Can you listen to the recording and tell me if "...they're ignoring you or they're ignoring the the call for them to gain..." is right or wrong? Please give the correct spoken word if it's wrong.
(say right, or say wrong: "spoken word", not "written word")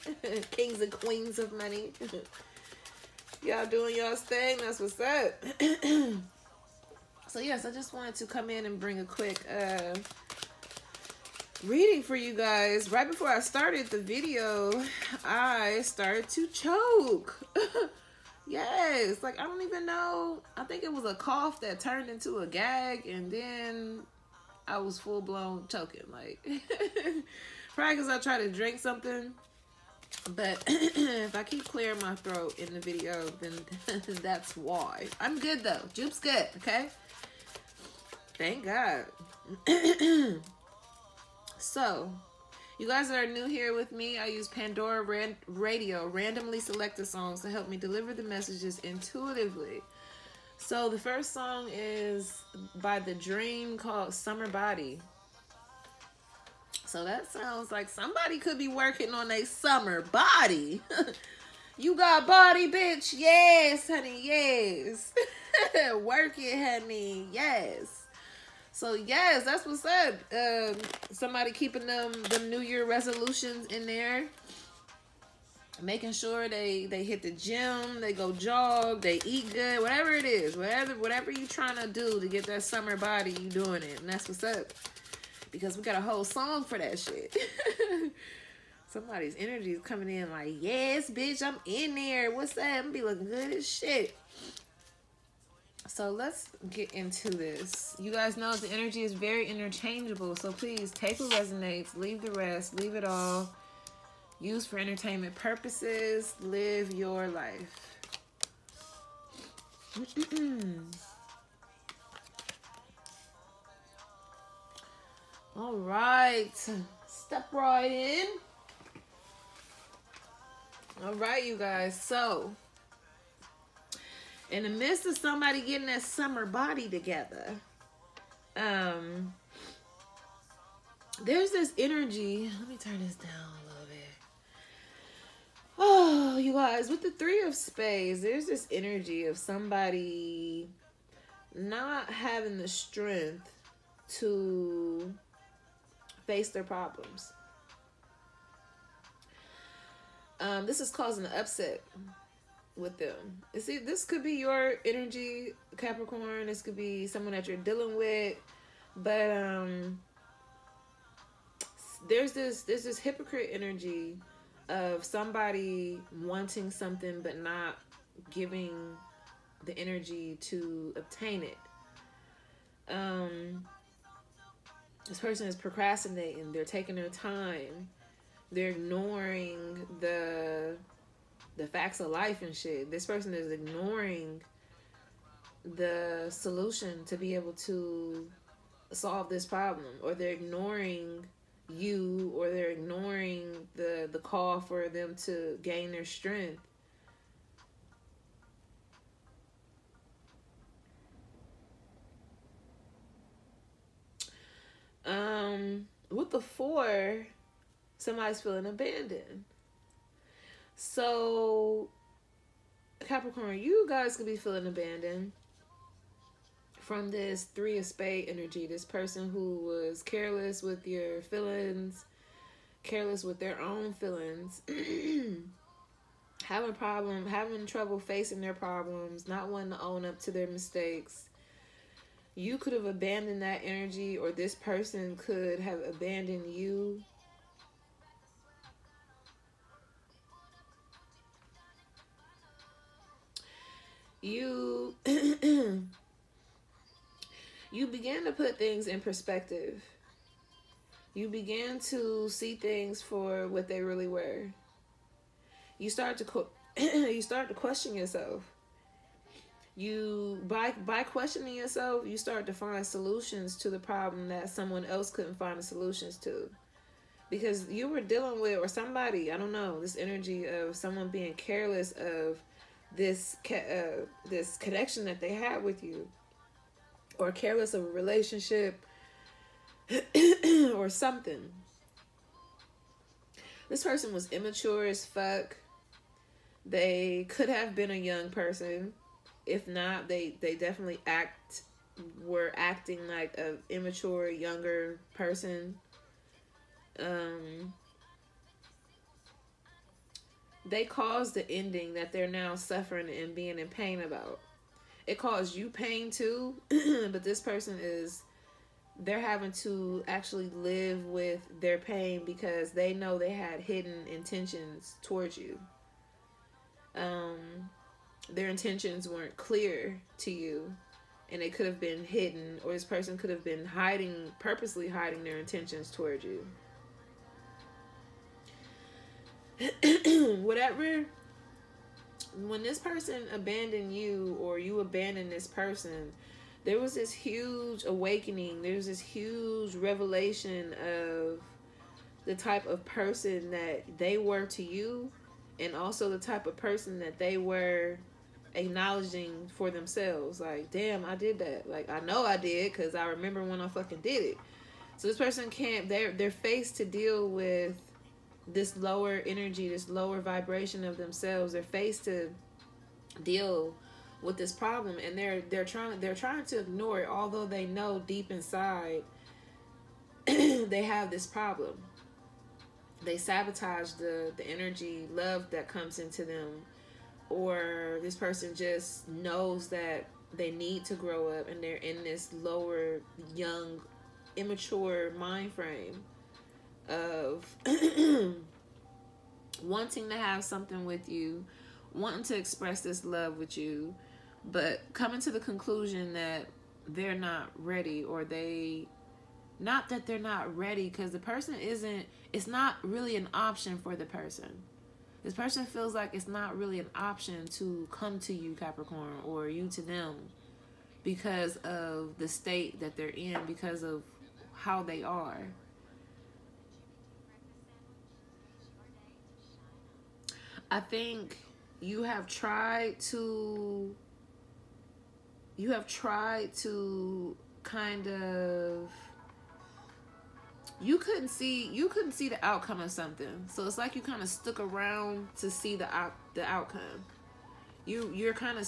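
right.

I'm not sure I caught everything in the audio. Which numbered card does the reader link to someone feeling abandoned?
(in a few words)
Four.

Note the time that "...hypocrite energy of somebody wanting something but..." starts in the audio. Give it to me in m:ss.
2:42.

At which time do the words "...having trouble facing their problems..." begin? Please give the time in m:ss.
3:47.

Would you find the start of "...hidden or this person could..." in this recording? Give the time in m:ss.
5:22.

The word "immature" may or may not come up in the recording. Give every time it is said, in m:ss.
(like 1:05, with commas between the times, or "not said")
4:44, 4:53, 6:24.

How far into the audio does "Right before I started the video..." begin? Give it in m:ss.
0:12.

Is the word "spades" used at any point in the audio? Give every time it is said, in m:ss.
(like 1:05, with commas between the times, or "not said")
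2:17, 3:37.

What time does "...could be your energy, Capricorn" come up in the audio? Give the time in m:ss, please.
2:34.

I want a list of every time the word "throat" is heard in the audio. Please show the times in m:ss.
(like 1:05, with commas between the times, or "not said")
0:32.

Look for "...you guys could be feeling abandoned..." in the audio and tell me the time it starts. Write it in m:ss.
3:33.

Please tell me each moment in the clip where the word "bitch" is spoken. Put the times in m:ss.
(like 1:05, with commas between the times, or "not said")
1:02, 1:31.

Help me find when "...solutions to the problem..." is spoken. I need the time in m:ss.
4:22.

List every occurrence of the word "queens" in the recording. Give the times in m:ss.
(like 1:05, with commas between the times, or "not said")
0:00.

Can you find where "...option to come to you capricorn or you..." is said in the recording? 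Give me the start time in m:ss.
6:46.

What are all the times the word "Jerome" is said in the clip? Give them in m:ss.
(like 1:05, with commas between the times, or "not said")
not said.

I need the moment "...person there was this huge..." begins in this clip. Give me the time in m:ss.
5:35.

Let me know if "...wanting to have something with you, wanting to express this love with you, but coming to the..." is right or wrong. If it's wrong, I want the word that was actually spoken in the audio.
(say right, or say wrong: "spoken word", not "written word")
right.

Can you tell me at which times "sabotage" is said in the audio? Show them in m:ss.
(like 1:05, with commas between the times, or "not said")
6:13.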